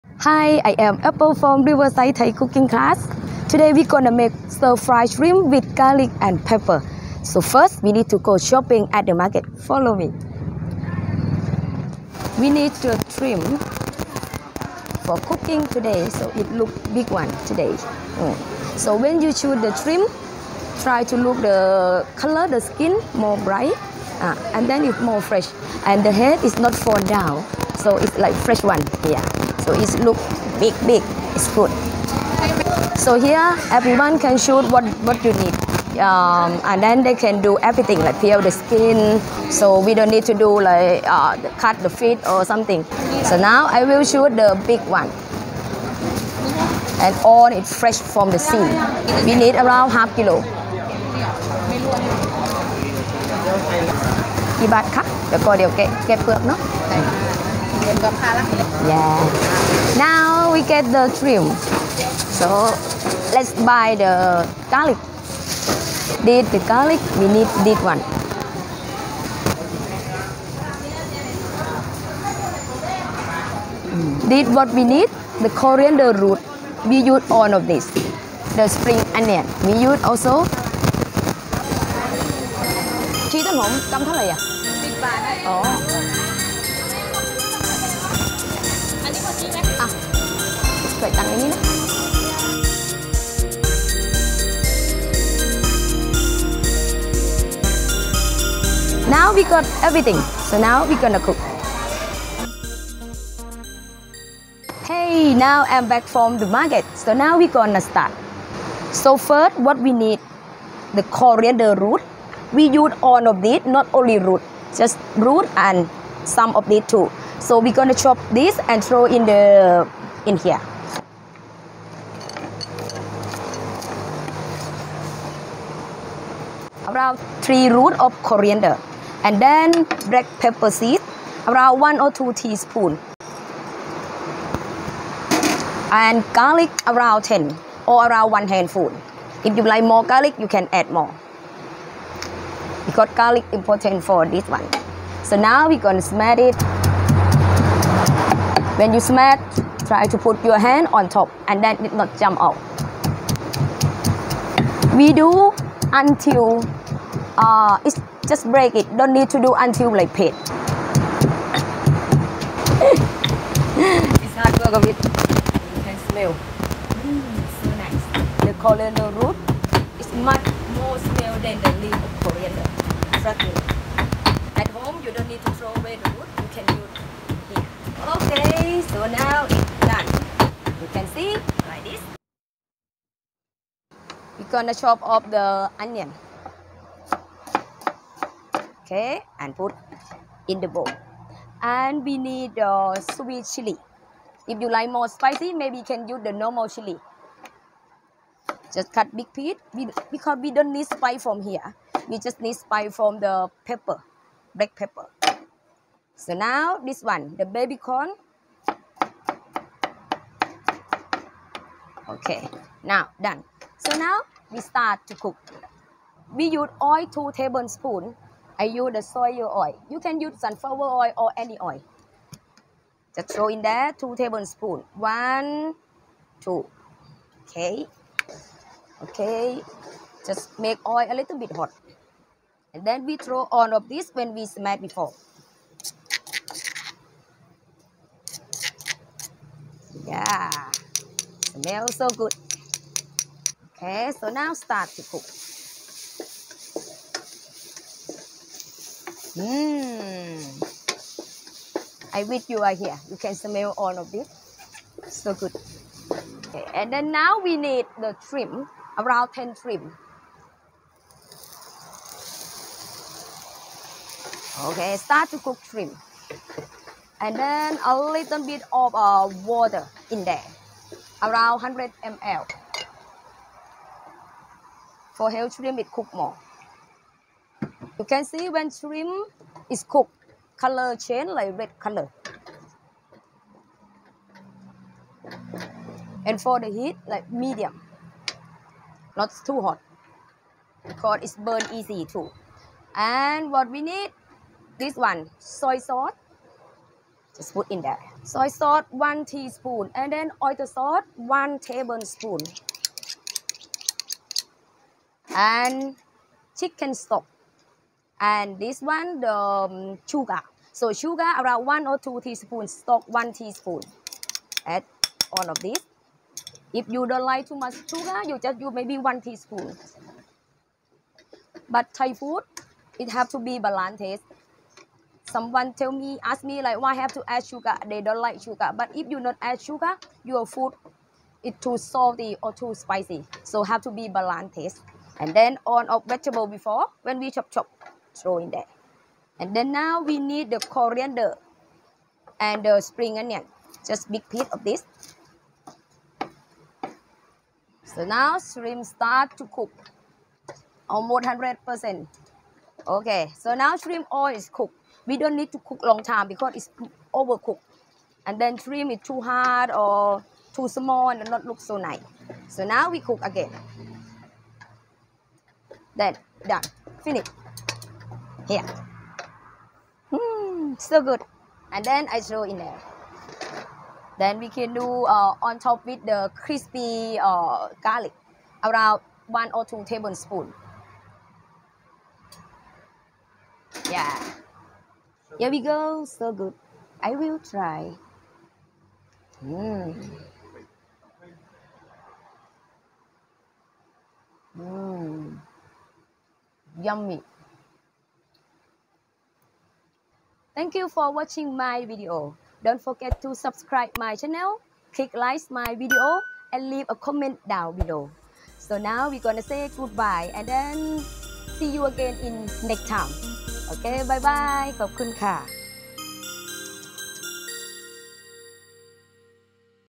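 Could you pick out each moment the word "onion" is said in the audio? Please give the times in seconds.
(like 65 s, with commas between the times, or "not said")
79 s, 185 s, 343 s.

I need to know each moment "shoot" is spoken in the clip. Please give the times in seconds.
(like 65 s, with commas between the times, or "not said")
34 s, 44 s.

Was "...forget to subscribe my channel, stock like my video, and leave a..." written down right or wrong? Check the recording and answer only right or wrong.
wrong.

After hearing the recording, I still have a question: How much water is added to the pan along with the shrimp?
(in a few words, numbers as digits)
100 ml.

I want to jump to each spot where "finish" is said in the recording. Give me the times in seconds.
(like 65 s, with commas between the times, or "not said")
367 s.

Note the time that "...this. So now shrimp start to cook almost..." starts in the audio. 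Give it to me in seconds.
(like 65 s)
344 s.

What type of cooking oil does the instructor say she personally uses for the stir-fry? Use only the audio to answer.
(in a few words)
soy oil.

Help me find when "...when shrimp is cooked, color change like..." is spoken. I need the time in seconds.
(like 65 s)
278 s.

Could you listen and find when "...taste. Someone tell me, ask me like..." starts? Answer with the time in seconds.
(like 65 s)
323 s.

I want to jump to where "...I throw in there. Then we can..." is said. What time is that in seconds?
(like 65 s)
372 s.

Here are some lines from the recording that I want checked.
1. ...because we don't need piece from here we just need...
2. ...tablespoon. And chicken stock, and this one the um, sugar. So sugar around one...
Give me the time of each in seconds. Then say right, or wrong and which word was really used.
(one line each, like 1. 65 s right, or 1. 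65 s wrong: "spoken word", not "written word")
1. 200 s wrong: "spice", not "piece"
2. 301 s right.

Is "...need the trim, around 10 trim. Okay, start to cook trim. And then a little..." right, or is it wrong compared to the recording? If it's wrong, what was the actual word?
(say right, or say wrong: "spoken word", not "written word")
right.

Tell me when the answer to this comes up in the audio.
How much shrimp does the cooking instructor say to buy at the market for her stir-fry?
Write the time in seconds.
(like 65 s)
49 s.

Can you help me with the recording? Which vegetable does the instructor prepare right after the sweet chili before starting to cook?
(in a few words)
baby corn.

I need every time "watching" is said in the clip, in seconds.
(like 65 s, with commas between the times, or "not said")
401 s.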